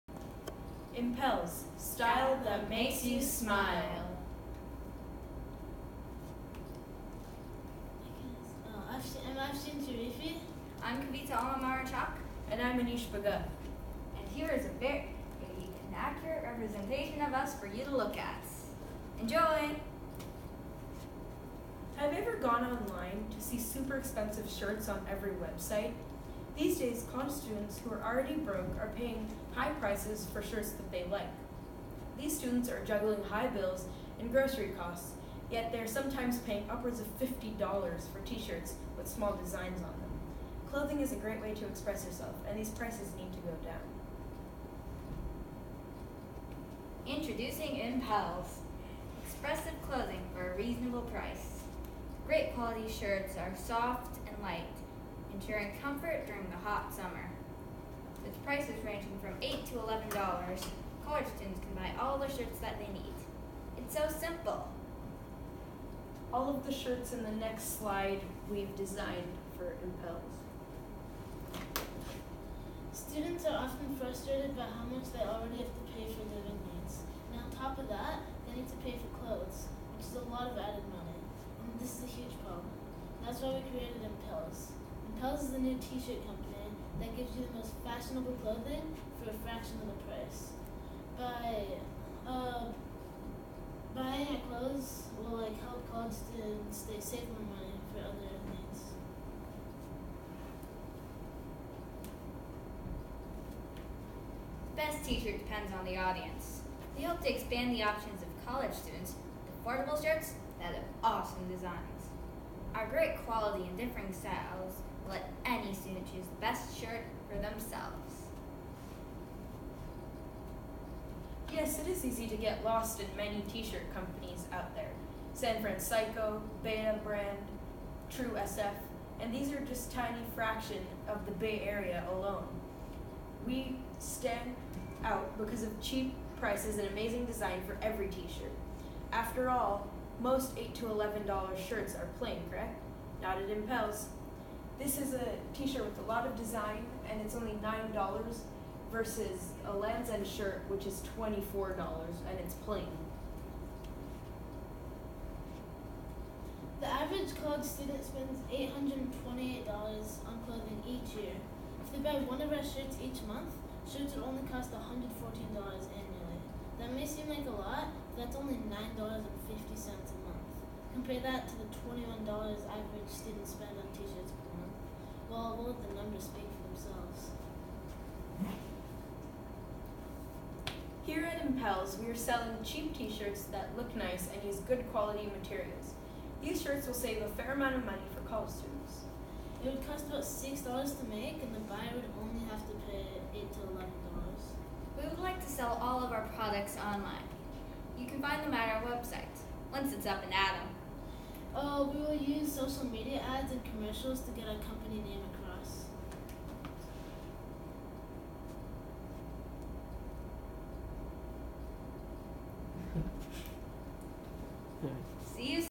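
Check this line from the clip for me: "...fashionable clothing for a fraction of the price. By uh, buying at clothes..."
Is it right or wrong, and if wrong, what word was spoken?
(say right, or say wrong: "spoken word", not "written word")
right.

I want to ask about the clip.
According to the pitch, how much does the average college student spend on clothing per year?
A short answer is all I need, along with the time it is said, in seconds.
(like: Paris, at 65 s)
$828, at 158 s.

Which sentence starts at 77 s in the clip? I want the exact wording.
And on top of that, they need to pay for clothes, which is a lot of added money.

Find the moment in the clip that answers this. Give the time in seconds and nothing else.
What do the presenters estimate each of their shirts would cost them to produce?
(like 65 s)
190 s.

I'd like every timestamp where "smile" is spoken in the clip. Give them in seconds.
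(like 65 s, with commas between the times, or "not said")
3 s.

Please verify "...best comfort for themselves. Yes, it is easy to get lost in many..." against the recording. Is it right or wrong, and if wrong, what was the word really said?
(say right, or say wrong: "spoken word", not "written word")
wrong: "shirt", not "comfort".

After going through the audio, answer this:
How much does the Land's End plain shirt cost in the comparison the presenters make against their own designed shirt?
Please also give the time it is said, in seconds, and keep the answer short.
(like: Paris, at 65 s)
$24, at 151 s.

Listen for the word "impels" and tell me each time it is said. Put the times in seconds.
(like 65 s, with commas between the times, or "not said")
1 s, 47 s, 69 s, 84 s, 143 s, 181 s.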